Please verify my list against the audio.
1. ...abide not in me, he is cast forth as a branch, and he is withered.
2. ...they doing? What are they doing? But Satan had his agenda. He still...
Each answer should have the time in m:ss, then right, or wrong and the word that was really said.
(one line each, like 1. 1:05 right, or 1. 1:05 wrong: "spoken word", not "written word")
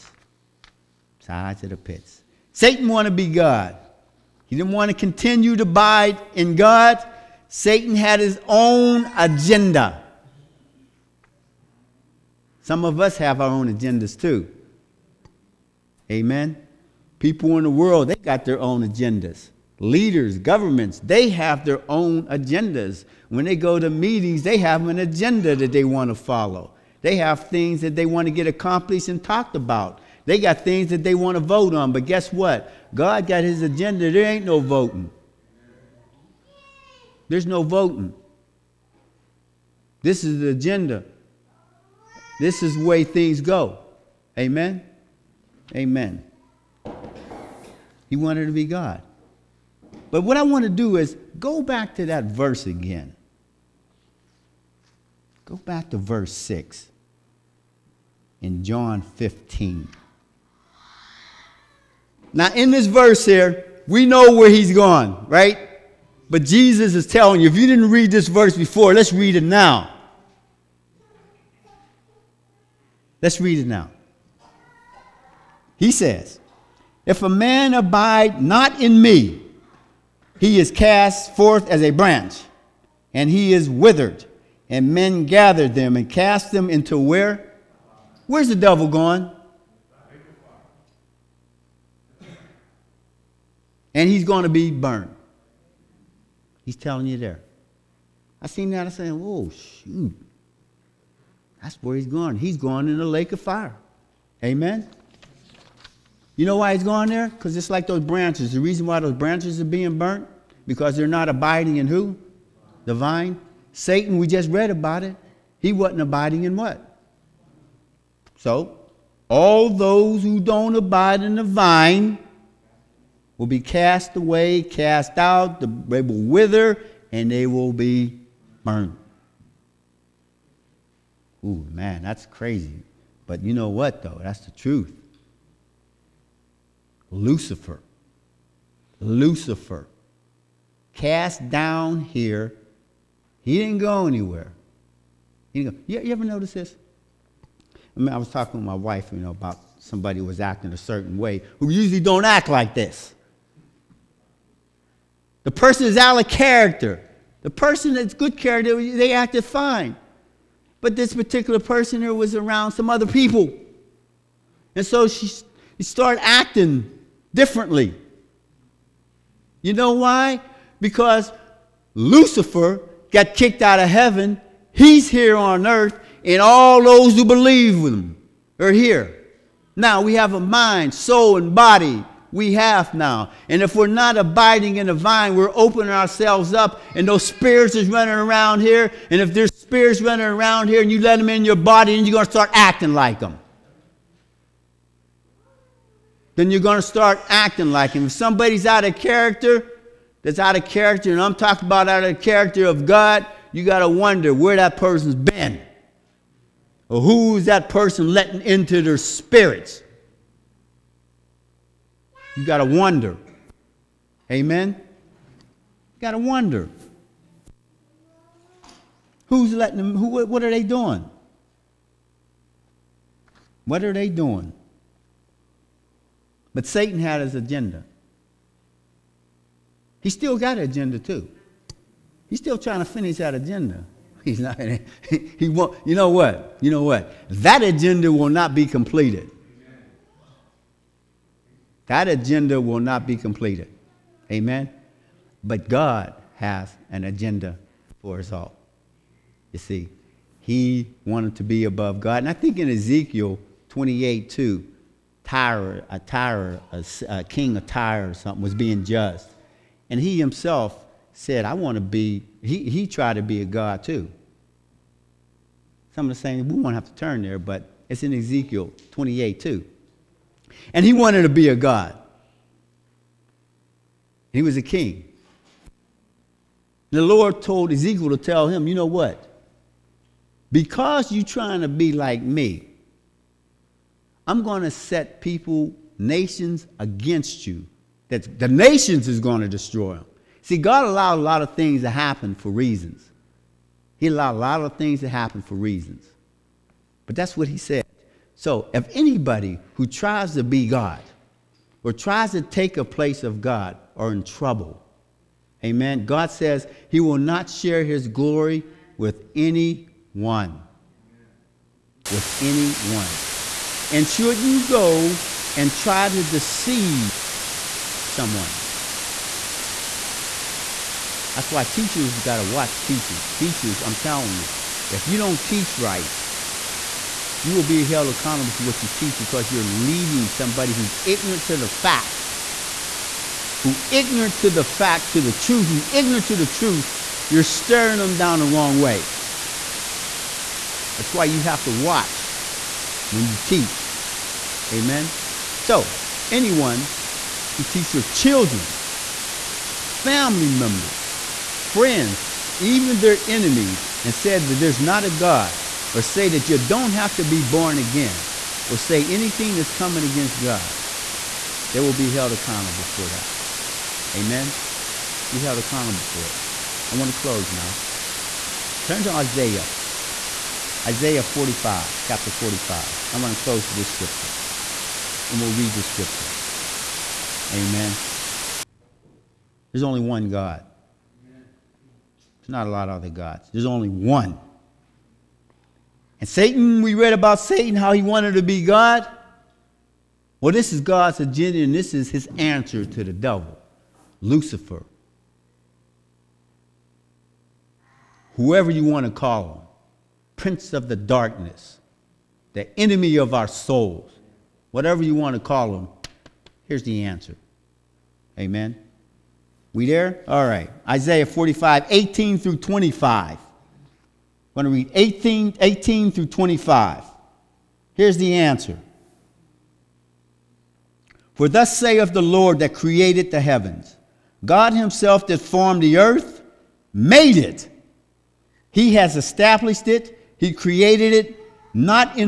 1. 1:17 right
2. 3:40 right.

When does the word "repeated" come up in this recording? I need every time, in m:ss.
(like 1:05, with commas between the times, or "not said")
not said.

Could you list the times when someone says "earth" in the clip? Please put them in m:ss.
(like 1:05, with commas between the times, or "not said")
2:55, 7:05.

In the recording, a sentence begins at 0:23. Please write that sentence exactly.
When they go to meetings, they have an agenda that they want to follow.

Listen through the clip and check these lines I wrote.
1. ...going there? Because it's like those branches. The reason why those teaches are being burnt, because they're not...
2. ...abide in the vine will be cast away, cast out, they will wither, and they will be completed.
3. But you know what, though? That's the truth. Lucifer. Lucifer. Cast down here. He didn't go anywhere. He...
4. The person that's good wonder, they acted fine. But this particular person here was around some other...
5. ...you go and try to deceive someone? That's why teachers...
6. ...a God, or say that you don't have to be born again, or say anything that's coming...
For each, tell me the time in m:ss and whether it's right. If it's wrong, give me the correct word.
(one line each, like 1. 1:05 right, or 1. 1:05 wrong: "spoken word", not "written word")
1. 1:46 wrong: "branches", not "teaches"
2. 2:00 wrong: "burned", not "completed"
3. 2:13 right
4. 2:37 wrong: "character", not "wonder"
5. 5:14 right
6. 5:55 right.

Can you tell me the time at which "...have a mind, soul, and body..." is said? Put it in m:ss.
3:00.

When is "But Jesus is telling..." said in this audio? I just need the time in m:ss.
1:06.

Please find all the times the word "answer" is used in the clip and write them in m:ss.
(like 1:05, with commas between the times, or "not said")
6:32, 6:47, 6:58.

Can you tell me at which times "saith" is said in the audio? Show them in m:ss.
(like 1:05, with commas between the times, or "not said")
7:01.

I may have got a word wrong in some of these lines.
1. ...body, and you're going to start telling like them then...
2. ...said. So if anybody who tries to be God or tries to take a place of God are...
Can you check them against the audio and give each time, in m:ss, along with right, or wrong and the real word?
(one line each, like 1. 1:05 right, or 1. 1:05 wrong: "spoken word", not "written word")
1. 3:11 wrong: "acting", not "telling"
2. 4:57 right.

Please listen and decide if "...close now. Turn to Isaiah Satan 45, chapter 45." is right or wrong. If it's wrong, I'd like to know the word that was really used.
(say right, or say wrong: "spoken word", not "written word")
wrong: "Isaiah", not "Satan".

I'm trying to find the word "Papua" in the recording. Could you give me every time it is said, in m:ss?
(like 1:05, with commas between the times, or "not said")
not said.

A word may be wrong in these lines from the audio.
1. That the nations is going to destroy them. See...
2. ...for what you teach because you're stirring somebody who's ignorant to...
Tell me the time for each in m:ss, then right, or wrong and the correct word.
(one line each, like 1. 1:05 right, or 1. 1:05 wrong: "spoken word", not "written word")
1. 4:48 right
2. 5:28 wrong: "leading", not "stirring".